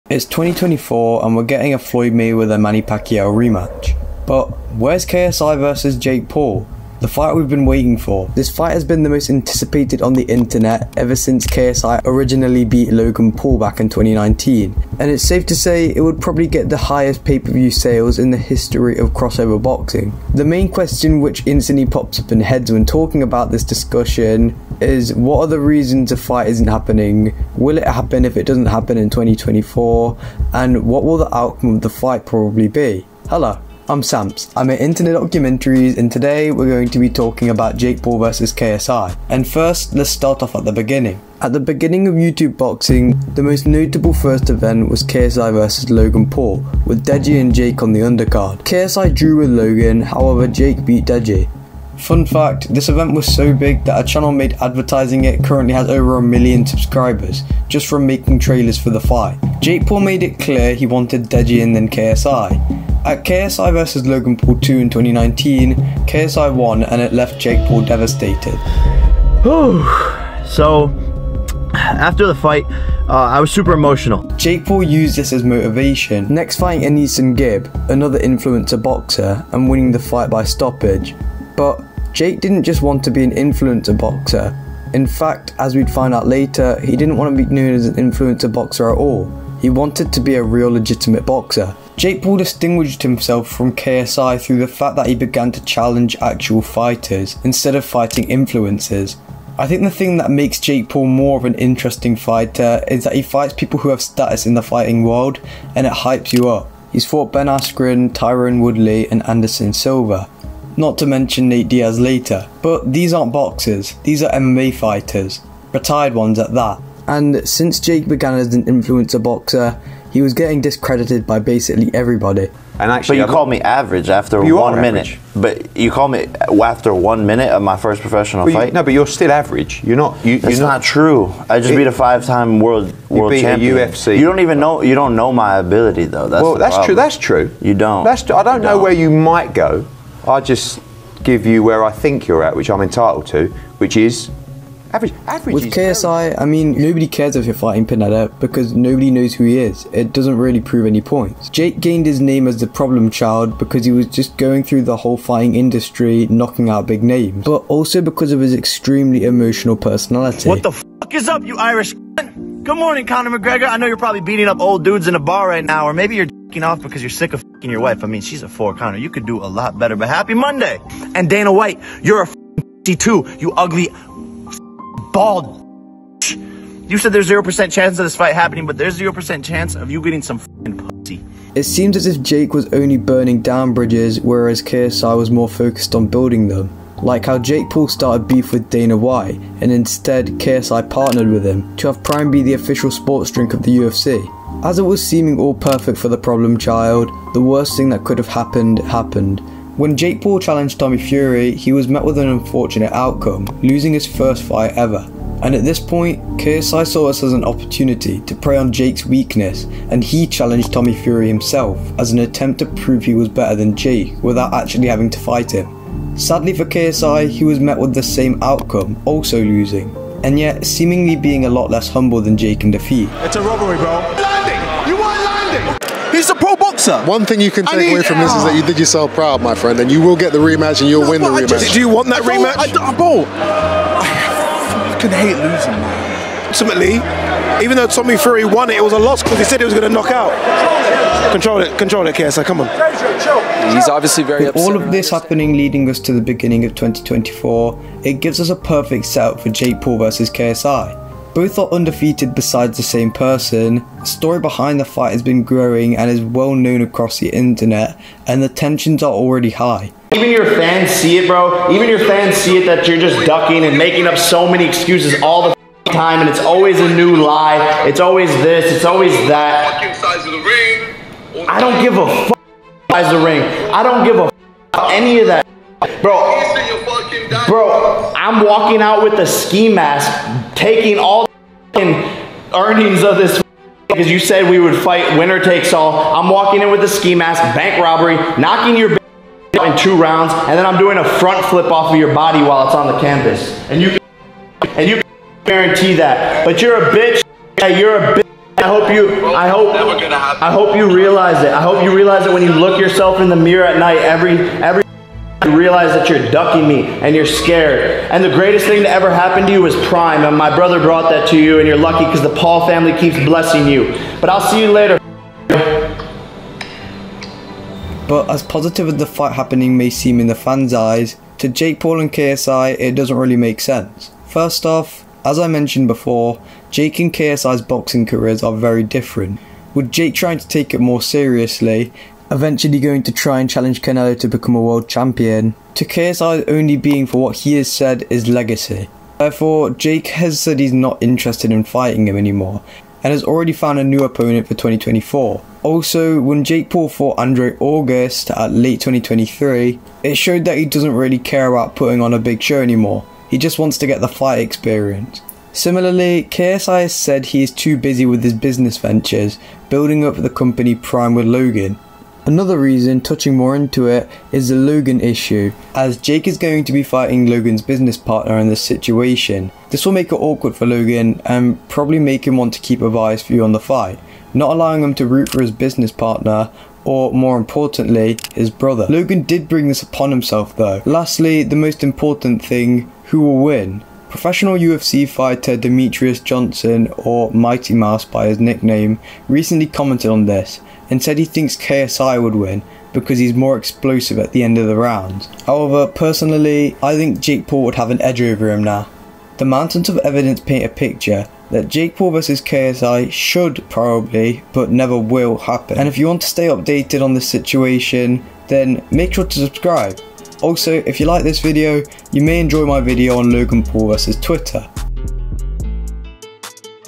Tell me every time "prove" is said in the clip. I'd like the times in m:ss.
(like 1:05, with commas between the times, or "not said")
2:30, 3:32.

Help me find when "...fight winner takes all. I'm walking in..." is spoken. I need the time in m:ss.
4:44.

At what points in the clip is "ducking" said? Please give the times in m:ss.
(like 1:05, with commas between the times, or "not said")
4:23, 5:06.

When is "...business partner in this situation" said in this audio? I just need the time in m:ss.
6:07.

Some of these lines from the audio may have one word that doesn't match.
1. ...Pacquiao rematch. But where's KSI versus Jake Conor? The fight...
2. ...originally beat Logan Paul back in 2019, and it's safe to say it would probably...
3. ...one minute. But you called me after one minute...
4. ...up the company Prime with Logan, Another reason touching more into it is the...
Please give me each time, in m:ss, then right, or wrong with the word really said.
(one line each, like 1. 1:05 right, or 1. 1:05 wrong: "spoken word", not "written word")
1. 0:02 wrong: "Paul", not "Conor"
2. 0:12 right
3. 2:04 right
4. 6:00 right.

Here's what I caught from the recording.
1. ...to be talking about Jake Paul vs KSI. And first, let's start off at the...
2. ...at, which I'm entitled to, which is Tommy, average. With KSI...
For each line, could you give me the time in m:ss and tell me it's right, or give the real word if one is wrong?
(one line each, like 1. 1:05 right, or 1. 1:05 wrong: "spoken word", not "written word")
1. 0:36 right
2. 2:22 wrong: "Average", not "Tommy".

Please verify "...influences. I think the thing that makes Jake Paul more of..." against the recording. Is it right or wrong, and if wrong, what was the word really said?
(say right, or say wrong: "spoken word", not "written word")
right.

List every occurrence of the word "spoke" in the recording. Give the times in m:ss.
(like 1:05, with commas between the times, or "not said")
not said.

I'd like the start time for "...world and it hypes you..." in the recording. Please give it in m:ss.
1:45.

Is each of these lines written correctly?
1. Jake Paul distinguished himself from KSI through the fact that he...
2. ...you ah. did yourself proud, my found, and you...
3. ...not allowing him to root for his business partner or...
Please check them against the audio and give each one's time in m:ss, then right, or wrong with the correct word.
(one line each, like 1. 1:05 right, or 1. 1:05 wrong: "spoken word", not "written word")
1. 1:31 right
2. 3:48 wrong: "friend", not "found"
3. 6:14 right.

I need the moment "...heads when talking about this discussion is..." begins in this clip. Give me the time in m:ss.
0:22.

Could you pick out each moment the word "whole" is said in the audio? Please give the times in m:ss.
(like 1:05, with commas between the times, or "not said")
2:34.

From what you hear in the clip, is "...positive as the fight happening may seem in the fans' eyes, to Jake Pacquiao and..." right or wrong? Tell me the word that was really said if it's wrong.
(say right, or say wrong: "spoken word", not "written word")
wrong: "Paul", not "Pacquiao".